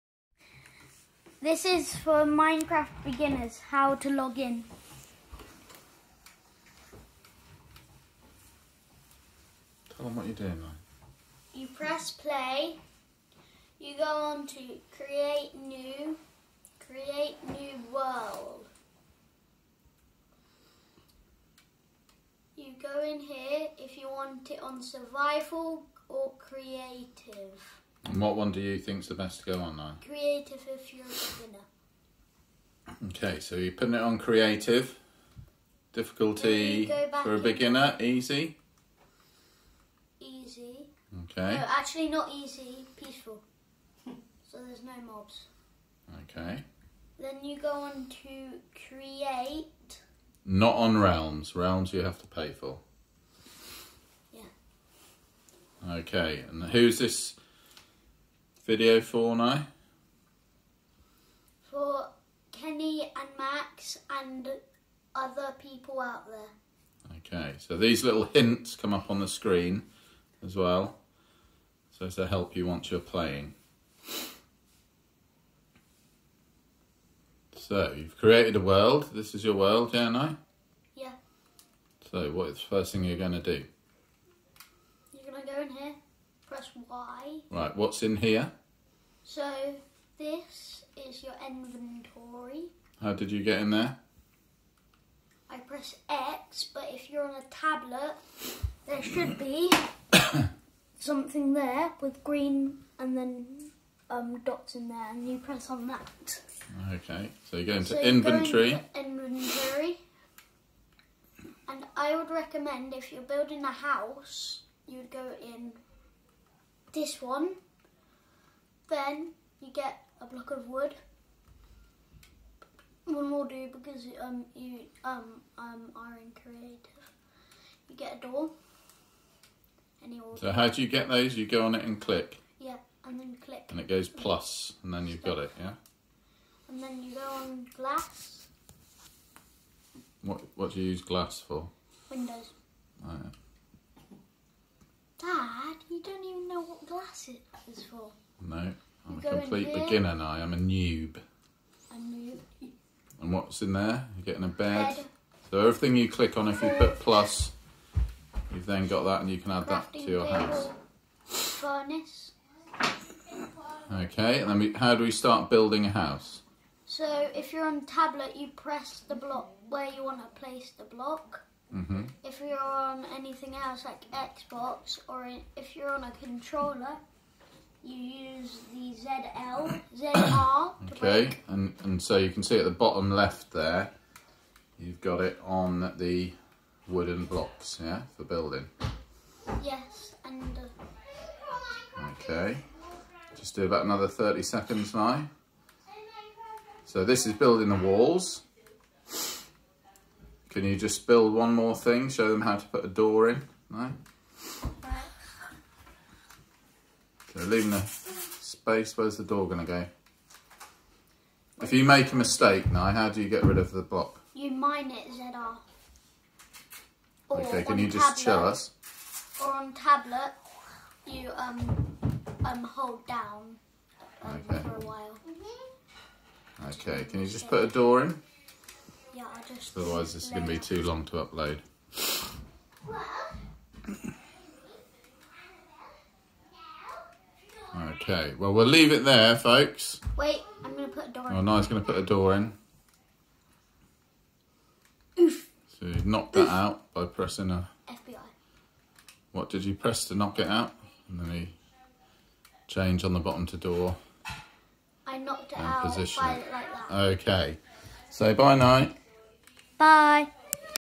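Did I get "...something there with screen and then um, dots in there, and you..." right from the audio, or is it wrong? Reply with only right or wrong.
wrong.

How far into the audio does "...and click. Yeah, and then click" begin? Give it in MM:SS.
02:11.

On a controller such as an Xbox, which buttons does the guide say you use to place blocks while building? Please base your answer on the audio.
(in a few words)
ZL, ZR.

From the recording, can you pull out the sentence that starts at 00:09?
Tell them what you're doing now.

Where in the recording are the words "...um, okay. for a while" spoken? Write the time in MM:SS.
03:44.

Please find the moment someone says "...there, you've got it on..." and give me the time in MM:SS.
03:03.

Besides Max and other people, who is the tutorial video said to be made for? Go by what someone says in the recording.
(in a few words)
Kenny.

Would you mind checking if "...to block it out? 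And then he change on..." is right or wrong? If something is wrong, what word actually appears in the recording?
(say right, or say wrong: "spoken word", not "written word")
wrong: "knock", not "block".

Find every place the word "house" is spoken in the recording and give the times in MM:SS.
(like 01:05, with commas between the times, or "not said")
01:53, 02:40, 02:45.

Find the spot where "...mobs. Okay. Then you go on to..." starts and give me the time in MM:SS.
00:45.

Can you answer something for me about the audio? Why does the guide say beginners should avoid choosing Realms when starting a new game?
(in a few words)
You have to pay.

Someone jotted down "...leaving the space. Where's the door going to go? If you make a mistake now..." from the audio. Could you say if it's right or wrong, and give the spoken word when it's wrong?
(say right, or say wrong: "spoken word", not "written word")
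right.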